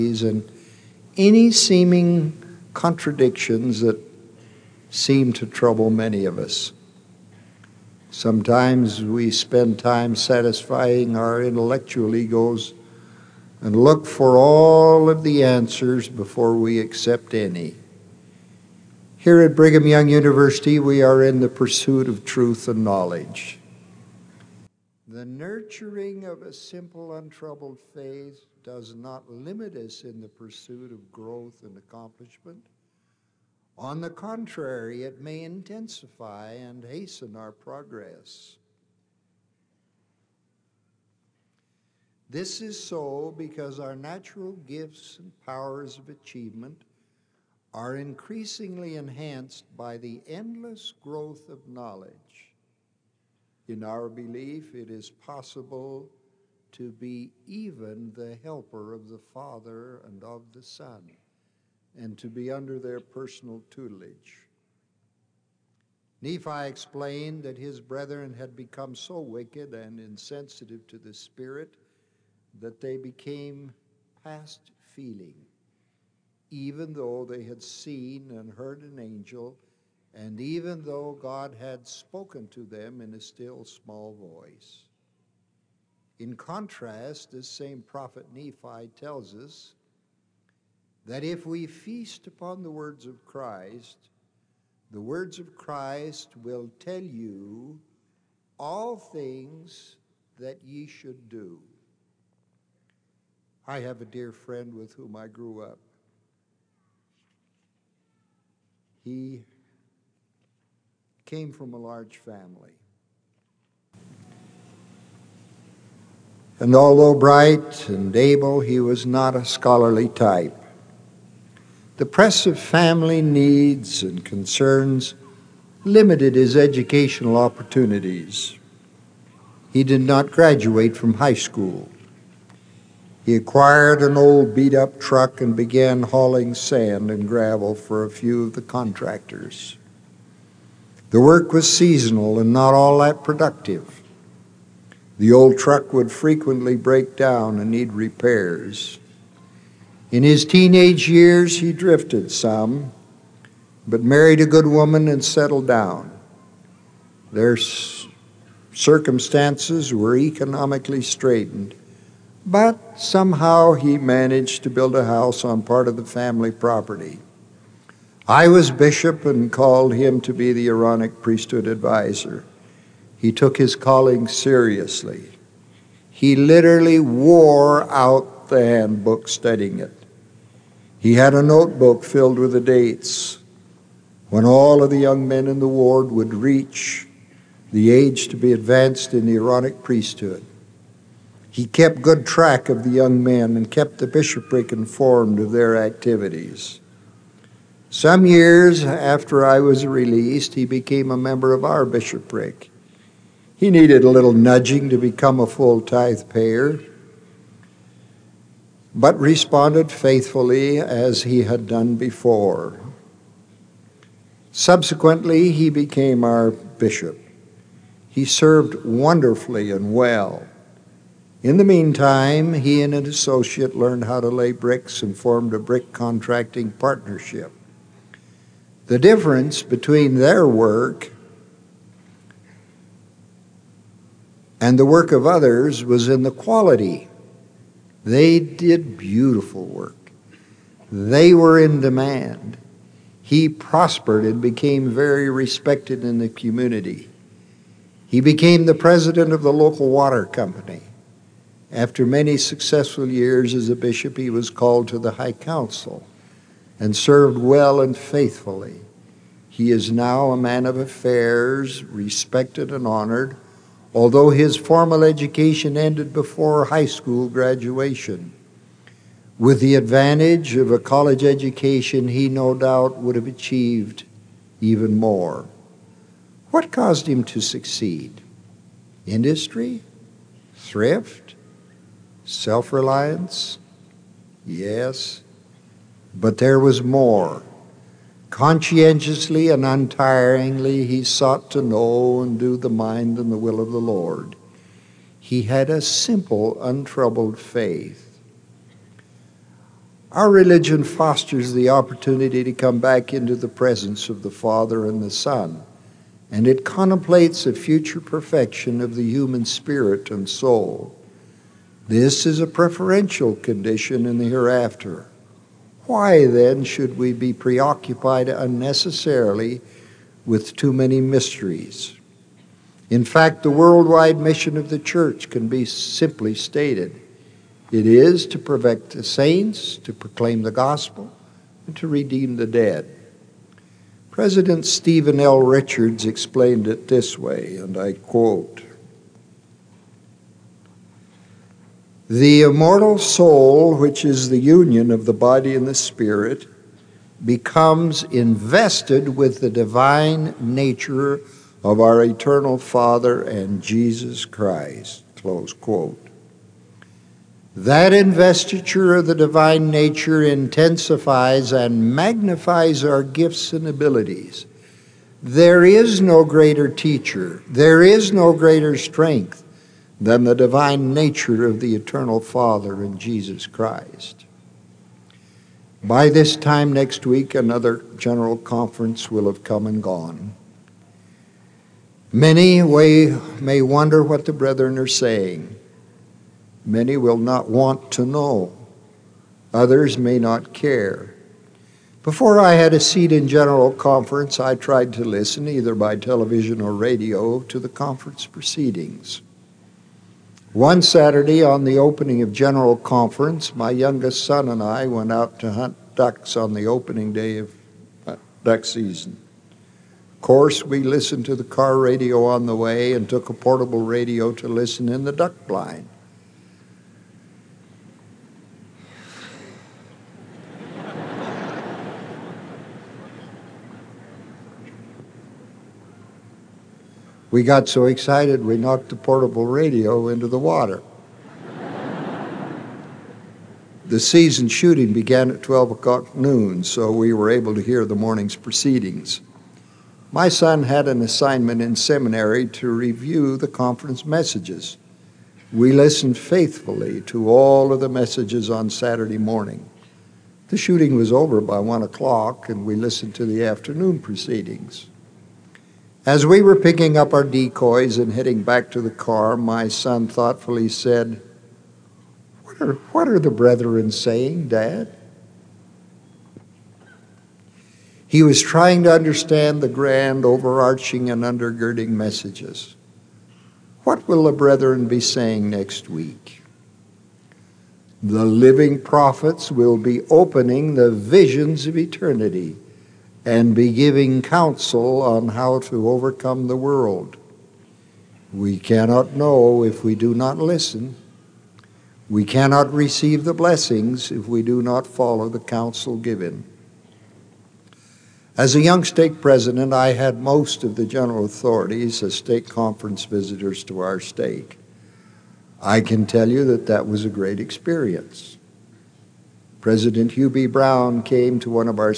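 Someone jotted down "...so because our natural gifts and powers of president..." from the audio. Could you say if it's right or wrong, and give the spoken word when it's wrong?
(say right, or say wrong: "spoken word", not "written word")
wrong: "achievement", not "president".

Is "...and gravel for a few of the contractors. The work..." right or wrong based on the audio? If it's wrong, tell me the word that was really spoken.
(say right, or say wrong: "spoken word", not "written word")
right.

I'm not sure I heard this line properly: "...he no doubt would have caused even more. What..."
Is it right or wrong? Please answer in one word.
wrong.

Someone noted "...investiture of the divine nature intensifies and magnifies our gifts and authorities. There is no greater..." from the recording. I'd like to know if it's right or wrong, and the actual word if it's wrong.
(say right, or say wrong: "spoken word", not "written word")
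wrong: "abilities", not "authorities".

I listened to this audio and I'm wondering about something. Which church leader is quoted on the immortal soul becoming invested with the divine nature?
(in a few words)
Stephen L. Richards.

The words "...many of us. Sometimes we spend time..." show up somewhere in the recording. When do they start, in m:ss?
0:05.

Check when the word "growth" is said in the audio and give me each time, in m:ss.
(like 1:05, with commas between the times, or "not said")
0:31, 0:50.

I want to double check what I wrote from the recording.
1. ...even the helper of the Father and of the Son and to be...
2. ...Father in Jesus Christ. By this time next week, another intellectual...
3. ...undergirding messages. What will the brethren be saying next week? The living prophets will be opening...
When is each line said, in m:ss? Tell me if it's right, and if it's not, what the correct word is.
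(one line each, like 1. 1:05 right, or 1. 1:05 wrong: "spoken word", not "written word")
1. 0:57 right
2. 6:12 wrong: "general", not "intellectual"
3. 7:51 right.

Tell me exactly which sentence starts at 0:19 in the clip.
Here at Brigham Young University, we are in the pursuit of truth and knowledge.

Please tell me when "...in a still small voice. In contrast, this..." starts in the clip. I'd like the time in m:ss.
1:23.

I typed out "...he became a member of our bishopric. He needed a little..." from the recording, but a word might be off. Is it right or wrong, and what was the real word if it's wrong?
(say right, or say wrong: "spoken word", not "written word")
right.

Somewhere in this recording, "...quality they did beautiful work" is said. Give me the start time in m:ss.
3:56.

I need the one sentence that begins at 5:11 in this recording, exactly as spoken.
This is a preferential condition in the hereafter.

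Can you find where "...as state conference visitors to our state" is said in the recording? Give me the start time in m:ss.
8:22.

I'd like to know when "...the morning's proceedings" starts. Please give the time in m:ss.
7:17.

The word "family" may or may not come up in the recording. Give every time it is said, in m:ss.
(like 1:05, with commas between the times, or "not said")
1:52, 2:02, 2:46.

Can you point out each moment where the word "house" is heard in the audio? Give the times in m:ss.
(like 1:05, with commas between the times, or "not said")
2:45.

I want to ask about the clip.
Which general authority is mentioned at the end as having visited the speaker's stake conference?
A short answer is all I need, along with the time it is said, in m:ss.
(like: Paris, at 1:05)
Hugh B. Brown, at 8:30.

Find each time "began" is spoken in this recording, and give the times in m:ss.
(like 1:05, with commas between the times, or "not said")
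2:15, 7:14.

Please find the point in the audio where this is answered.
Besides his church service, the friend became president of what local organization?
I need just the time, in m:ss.
4:09.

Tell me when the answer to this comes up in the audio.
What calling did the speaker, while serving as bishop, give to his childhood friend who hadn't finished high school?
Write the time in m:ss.
2:50.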